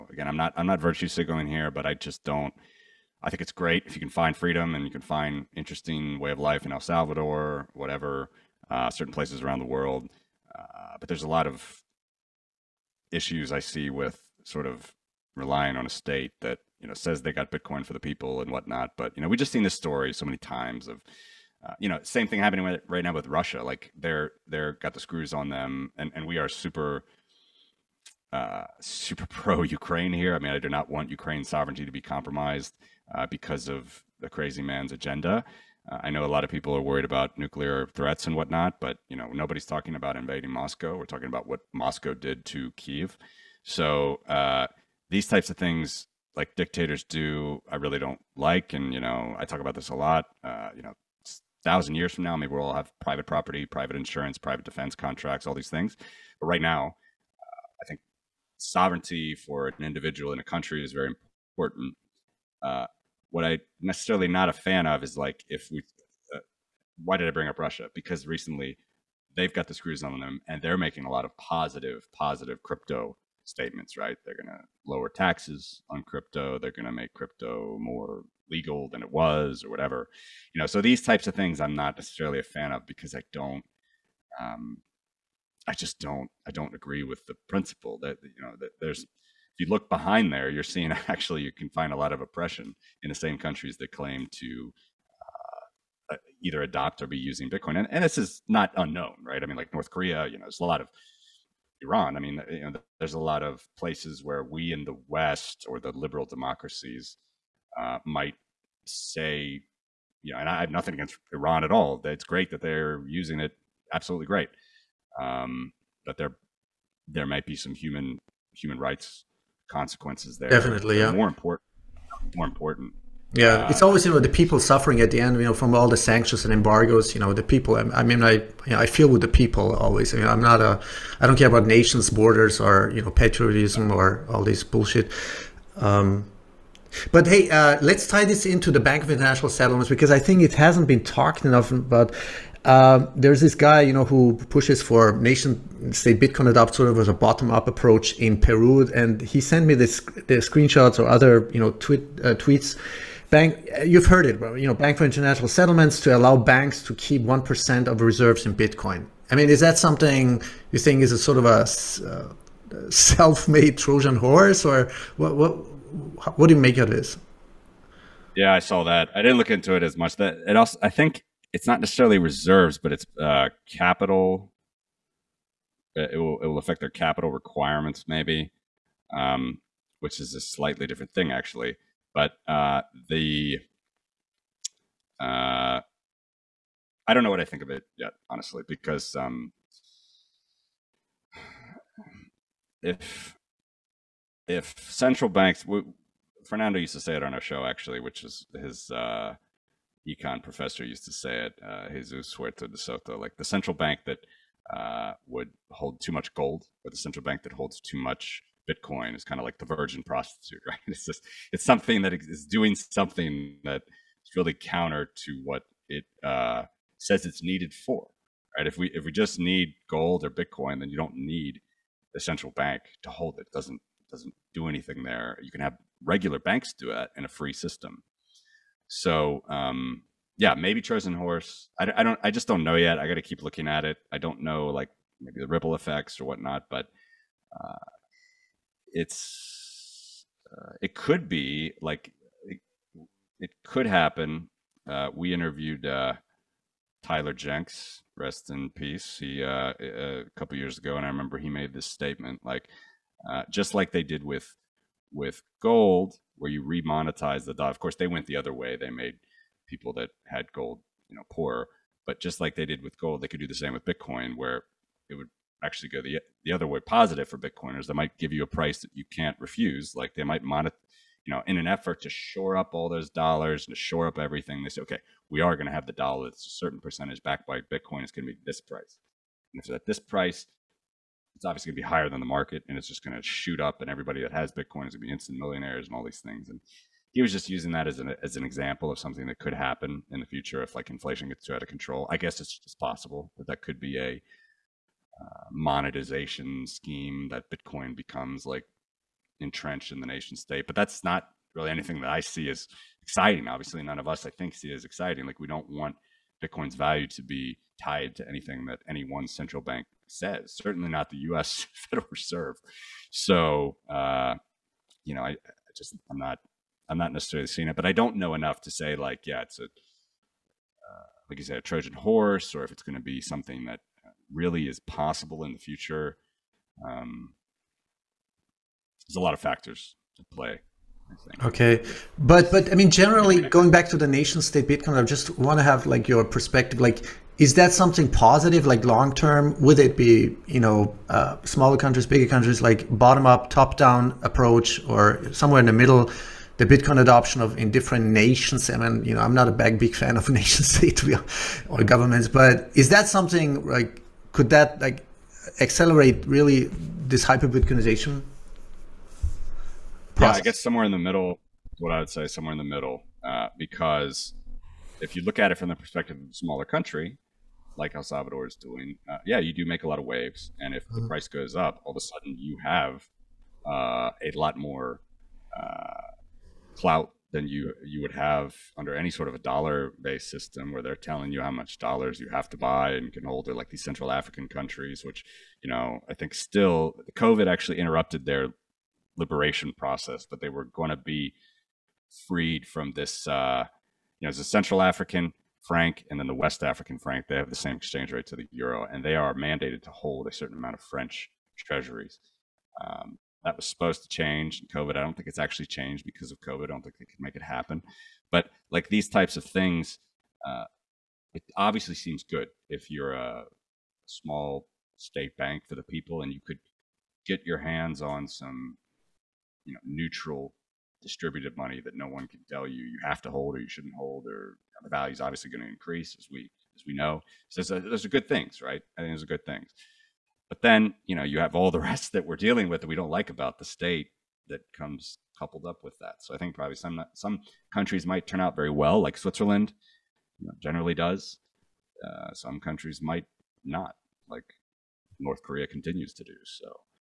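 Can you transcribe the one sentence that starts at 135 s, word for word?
Um, but hey, uh, let's tie this into the Bank of International Settlements because I think it hasn't been talked enough about.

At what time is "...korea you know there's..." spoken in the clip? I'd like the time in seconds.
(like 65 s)
99 s.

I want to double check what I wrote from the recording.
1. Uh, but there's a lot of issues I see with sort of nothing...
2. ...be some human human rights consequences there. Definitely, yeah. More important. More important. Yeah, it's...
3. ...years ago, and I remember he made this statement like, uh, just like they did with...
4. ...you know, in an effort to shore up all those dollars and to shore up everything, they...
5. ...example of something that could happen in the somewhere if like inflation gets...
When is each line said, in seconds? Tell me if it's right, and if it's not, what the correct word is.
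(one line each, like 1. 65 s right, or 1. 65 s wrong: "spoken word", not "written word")
1. 10 s wrong: "relying", not "nothing"
2. 117 s right
3. 250 s right
4. 271 s right
5. 288 s wrong: "future", not "somewhere".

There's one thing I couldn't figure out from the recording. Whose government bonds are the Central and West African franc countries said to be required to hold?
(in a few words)
French treasuries.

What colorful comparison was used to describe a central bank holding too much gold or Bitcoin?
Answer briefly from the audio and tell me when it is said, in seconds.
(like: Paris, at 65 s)
Virgin prostitute, at 209 s.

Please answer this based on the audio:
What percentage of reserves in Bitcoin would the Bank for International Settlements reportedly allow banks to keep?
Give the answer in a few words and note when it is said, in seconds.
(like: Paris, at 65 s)
1%, at 157 s.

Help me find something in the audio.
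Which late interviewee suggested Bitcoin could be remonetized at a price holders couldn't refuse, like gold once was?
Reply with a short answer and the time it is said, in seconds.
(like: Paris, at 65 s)
Tyler Jenks, at 247 s.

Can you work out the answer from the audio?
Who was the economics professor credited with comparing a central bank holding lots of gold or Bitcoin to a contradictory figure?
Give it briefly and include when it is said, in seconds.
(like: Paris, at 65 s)
Jesus Huerta de Soto, at 201 s.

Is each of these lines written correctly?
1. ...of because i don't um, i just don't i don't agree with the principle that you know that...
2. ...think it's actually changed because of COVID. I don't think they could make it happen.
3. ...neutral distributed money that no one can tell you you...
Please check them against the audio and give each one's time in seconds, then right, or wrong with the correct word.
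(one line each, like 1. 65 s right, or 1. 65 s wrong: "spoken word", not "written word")
1. 82 s right
2. 405 s right
3. 419 s right.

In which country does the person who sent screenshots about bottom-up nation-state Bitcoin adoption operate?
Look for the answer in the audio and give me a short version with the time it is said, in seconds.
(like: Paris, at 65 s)
Peru, at 148 s.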